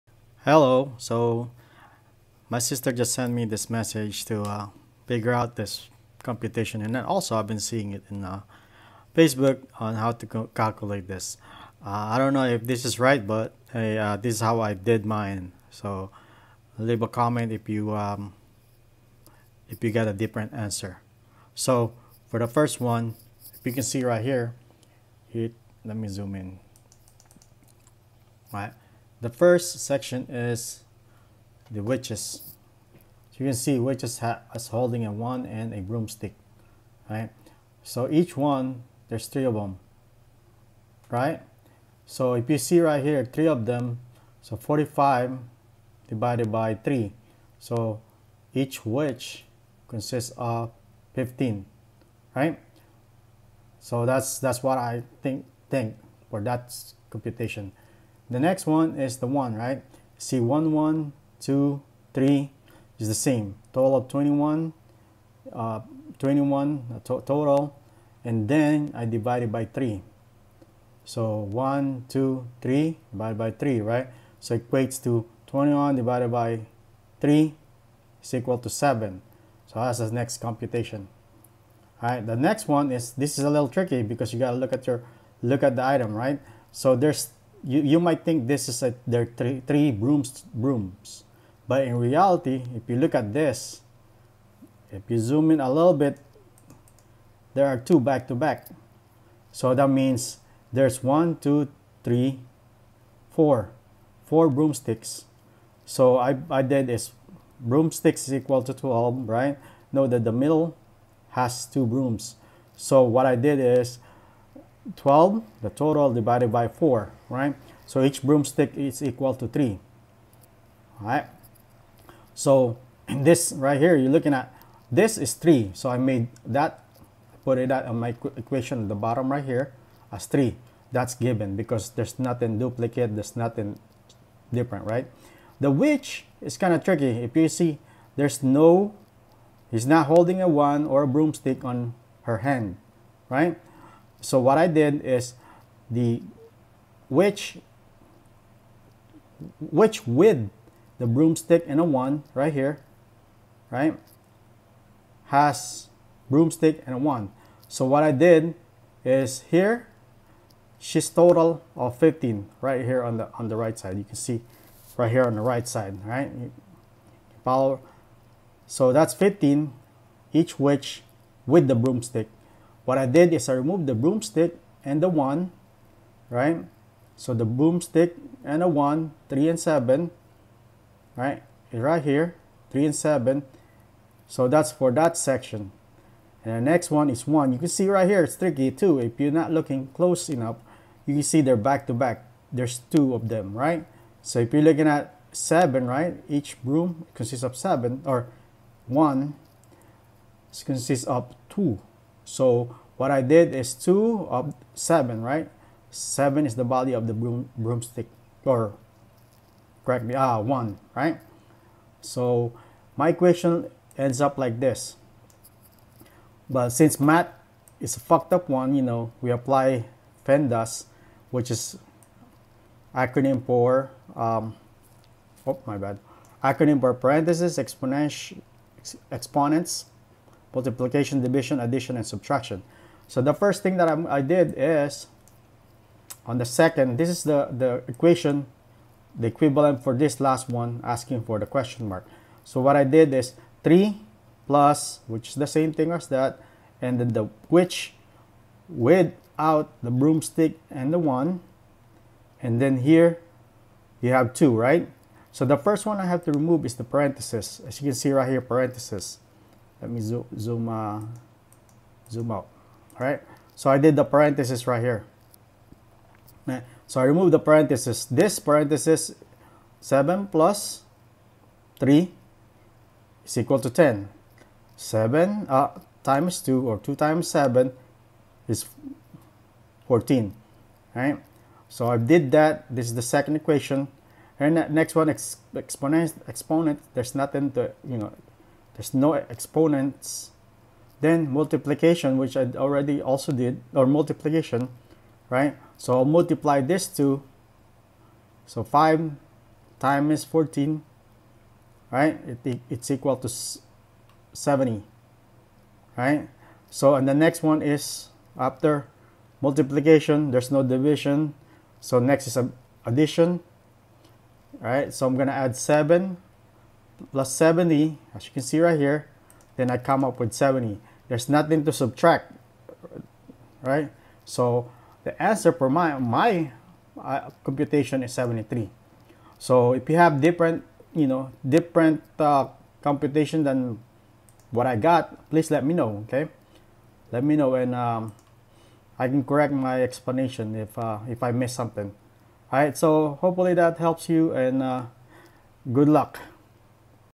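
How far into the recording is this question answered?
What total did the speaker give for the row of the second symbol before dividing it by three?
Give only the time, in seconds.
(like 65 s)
63 s.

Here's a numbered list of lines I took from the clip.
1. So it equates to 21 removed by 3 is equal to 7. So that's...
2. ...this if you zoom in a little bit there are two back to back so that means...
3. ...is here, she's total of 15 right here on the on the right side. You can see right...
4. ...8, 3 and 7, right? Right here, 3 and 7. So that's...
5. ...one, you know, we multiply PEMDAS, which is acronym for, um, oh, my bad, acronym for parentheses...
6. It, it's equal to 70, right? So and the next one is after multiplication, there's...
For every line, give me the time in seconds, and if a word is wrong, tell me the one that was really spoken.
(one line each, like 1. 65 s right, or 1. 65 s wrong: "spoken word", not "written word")
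1. 74 s wrong: "divided", not "removed"
2. 93 s right
3. 159 s right
4. 178 s wrong: "1", not "8"
5. 218 s wrong: "apply", not "multiply"
6. 302 s right.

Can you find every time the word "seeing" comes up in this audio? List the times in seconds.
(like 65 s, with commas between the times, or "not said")
7 s.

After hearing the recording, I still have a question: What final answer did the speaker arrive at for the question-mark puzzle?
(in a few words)
73.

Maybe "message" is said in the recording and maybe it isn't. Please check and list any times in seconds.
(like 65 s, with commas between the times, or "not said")
3 s.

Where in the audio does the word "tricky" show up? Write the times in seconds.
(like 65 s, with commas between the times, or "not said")
83 s, 136 s, 188 s.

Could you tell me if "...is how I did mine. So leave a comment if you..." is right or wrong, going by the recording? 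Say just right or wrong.
right.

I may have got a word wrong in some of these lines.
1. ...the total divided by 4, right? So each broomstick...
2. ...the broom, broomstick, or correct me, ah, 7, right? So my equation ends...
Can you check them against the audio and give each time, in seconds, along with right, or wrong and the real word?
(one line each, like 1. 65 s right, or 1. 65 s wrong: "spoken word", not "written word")
1. 115 s right
2. 207 s wrong: "1", not "7".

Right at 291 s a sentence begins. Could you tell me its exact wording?
Then multiplication, which I already also did, or multiplication, right?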